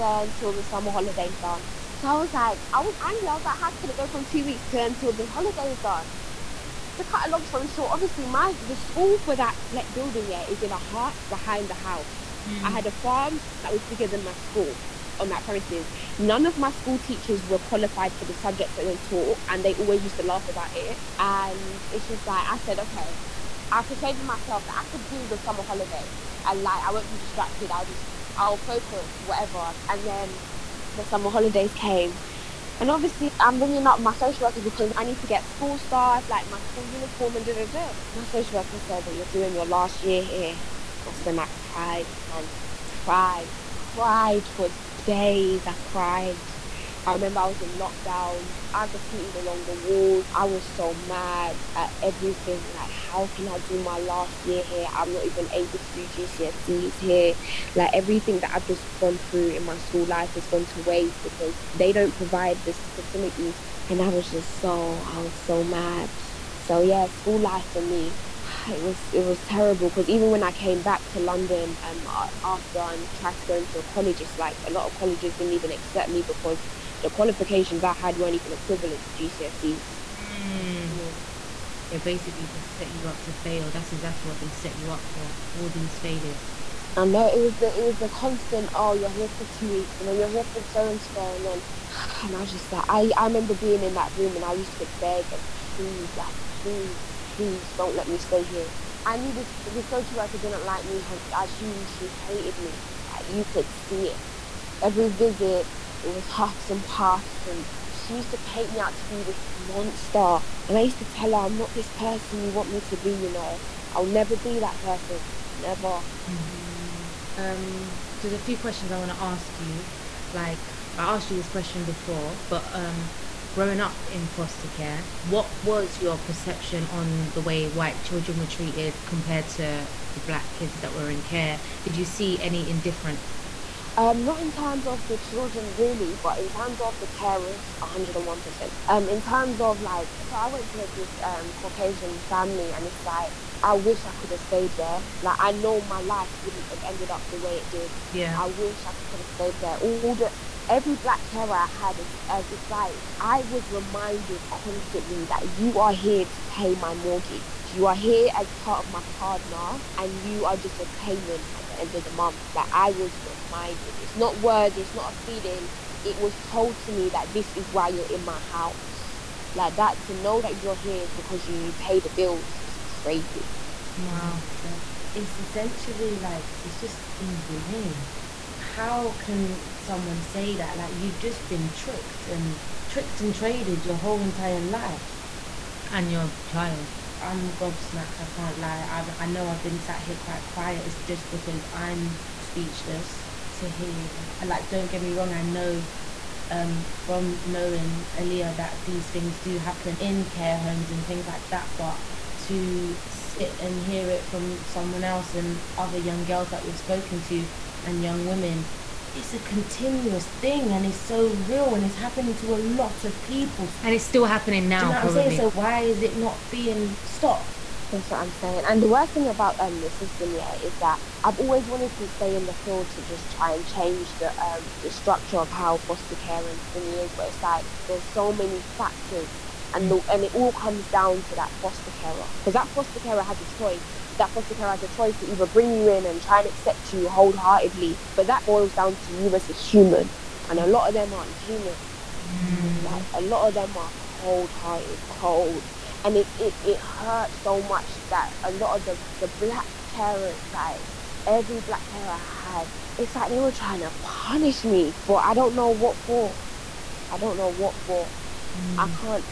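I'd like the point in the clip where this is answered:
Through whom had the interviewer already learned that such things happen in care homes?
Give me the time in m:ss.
3:18.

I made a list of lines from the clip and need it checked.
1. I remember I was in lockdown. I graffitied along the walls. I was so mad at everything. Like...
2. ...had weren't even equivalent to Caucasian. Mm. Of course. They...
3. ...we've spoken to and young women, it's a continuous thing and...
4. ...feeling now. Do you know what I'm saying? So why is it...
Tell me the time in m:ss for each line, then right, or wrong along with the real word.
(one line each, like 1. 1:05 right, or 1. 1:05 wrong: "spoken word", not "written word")
1. 0:47 right
2. 1:17 wrong: "GCSEs", not "Caucasian"
3. 3:26 right
4. 3:34 wrong: "happening", not "feeling".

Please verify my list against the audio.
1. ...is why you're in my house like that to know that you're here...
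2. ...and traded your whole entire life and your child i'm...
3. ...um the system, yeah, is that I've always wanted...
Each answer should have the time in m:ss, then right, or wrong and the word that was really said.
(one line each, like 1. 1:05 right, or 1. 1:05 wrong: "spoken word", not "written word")
1. 2:47 right
2. 3:03 right
3. 3:39 right.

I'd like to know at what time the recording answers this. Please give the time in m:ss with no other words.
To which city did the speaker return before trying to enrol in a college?
1:11.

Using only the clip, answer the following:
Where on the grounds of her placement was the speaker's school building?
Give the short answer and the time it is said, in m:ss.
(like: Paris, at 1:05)
In a hut behind the house, at 0:10.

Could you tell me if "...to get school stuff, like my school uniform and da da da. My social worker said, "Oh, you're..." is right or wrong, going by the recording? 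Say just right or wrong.
right.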